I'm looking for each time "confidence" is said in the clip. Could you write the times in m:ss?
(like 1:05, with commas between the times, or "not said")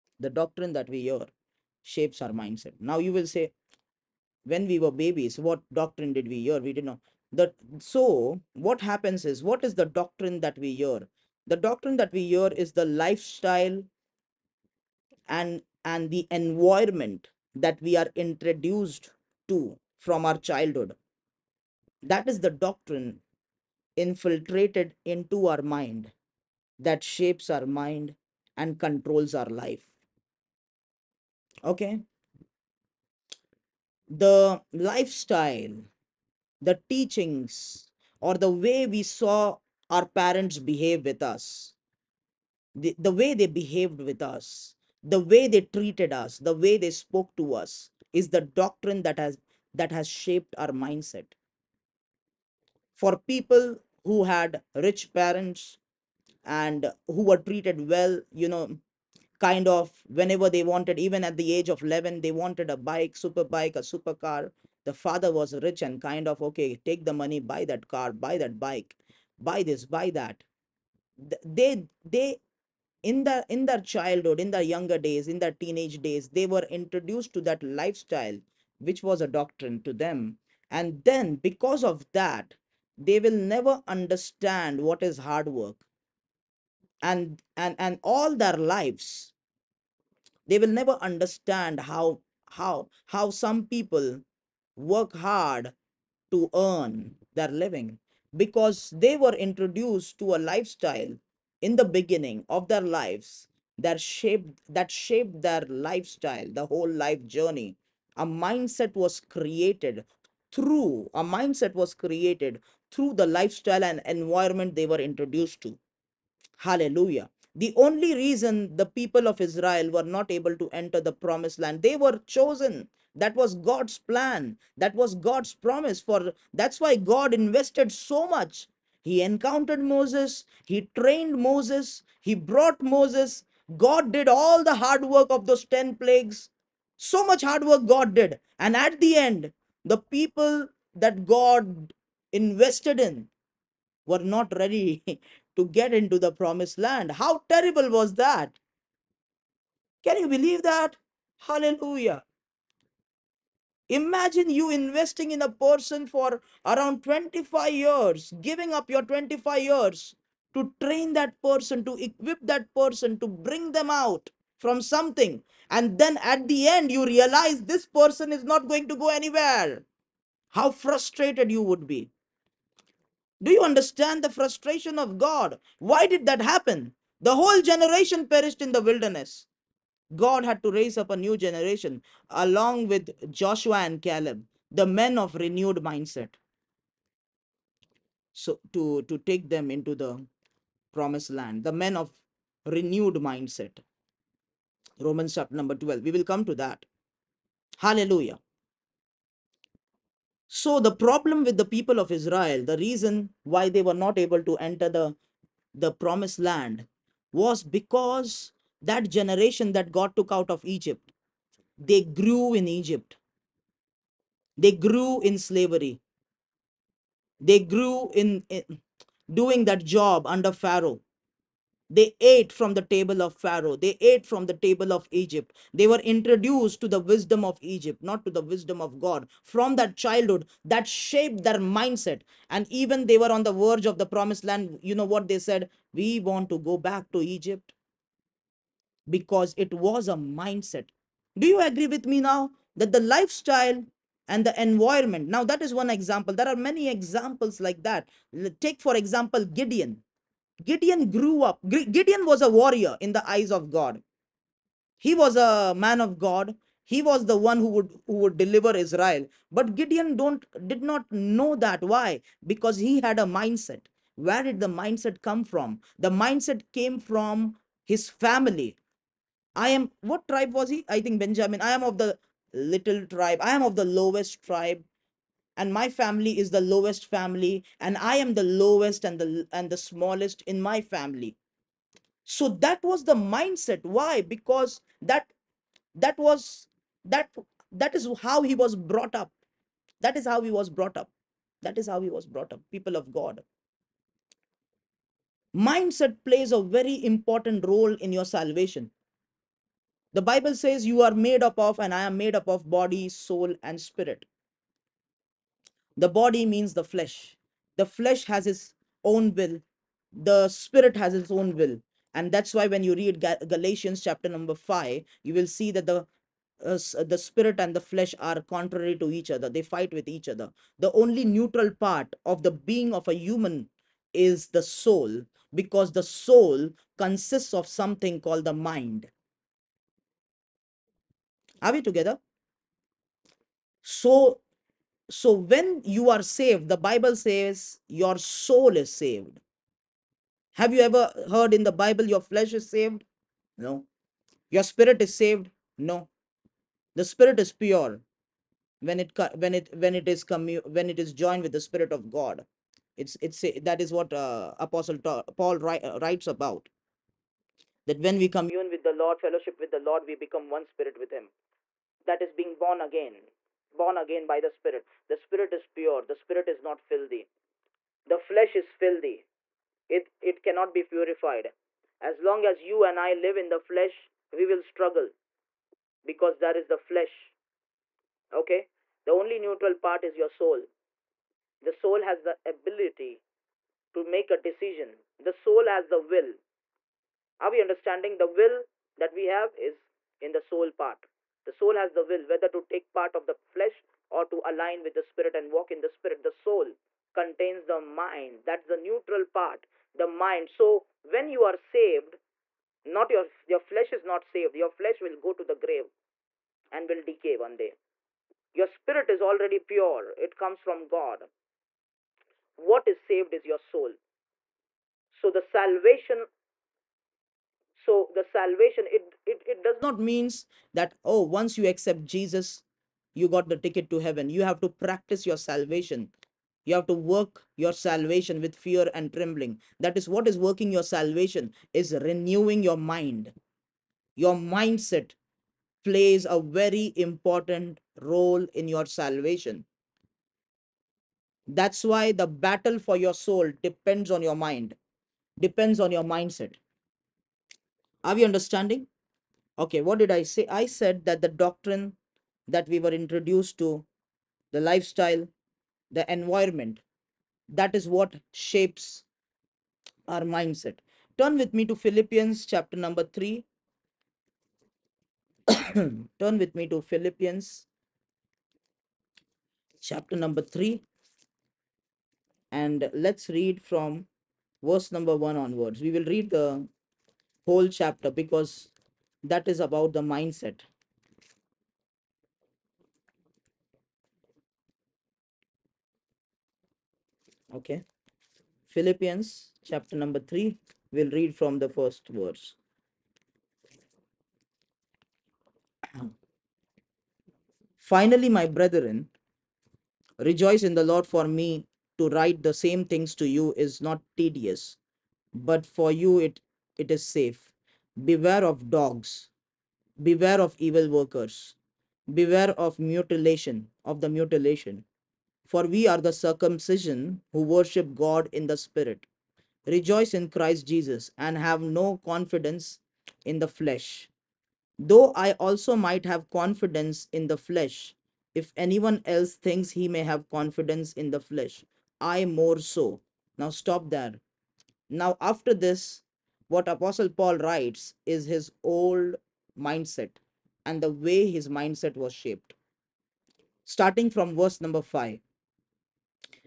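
8:42, 8:46, 8:50.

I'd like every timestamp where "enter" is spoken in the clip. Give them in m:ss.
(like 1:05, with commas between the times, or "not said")
2:00, 3:24.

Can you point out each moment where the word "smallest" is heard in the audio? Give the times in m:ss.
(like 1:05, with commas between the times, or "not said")
4:39.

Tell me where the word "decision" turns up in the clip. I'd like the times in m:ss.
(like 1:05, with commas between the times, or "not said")
6:24.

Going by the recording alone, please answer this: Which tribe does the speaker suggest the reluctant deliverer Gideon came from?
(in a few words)
Benjamin.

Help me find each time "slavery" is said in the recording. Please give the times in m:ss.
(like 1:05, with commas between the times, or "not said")
3:35.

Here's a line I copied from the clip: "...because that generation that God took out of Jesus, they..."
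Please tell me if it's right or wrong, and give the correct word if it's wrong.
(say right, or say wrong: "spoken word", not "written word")
wrong: "Egypt", not "Jesus".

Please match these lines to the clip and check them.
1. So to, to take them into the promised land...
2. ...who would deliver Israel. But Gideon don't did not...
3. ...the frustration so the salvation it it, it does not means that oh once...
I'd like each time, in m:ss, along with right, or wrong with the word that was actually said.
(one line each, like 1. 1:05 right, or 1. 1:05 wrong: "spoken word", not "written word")
1. 3:08 right
2. 4:18 right
3. 6:55 wrong: "salvation", not "frustration".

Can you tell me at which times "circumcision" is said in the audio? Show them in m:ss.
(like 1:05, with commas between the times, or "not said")
8:36.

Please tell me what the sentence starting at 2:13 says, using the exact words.
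God did all the hard work of those 10 plagues.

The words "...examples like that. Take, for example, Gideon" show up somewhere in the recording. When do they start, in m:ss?
4:06.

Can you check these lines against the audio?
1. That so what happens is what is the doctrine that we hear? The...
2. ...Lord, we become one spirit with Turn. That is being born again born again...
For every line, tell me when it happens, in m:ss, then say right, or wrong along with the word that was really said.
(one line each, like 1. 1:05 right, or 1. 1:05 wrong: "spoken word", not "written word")
1. 0:07 right
2. 5:59 wrong: "Him", not "Turn".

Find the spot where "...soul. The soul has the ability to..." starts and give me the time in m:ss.
6:20.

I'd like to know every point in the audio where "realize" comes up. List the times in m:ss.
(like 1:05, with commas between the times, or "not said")
2:47.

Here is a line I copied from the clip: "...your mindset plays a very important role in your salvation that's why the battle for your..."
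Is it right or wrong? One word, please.
right.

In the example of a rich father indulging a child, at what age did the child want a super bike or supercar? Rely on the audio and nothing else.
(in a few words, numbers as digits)
11.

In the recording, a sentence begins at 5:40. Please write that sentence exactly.
Have you ever heard in the Bible your flesh is saved?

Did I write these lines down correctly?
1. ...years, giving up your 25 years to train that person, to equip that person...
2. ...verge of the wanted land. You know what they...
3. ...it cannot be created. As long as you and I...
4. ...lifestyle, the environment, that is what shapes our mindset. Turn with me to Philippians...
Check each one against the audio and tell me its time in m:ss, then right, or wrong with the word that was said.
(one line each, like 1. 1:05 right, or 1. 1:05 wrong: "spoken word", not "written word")
1. 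2:37 right
2. 3:53 wrong: "promised", not "wanted"
3. 6:10 wrong: "purified", not "created"
4. 7:34 right.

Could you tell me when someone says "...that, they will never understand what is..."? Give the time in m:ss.
1:22.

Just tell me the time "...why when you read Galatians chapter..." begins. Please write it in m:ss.
5:12.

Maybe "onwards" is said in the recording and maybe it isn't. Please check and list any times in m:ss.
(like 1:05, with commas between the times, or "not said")
7:55.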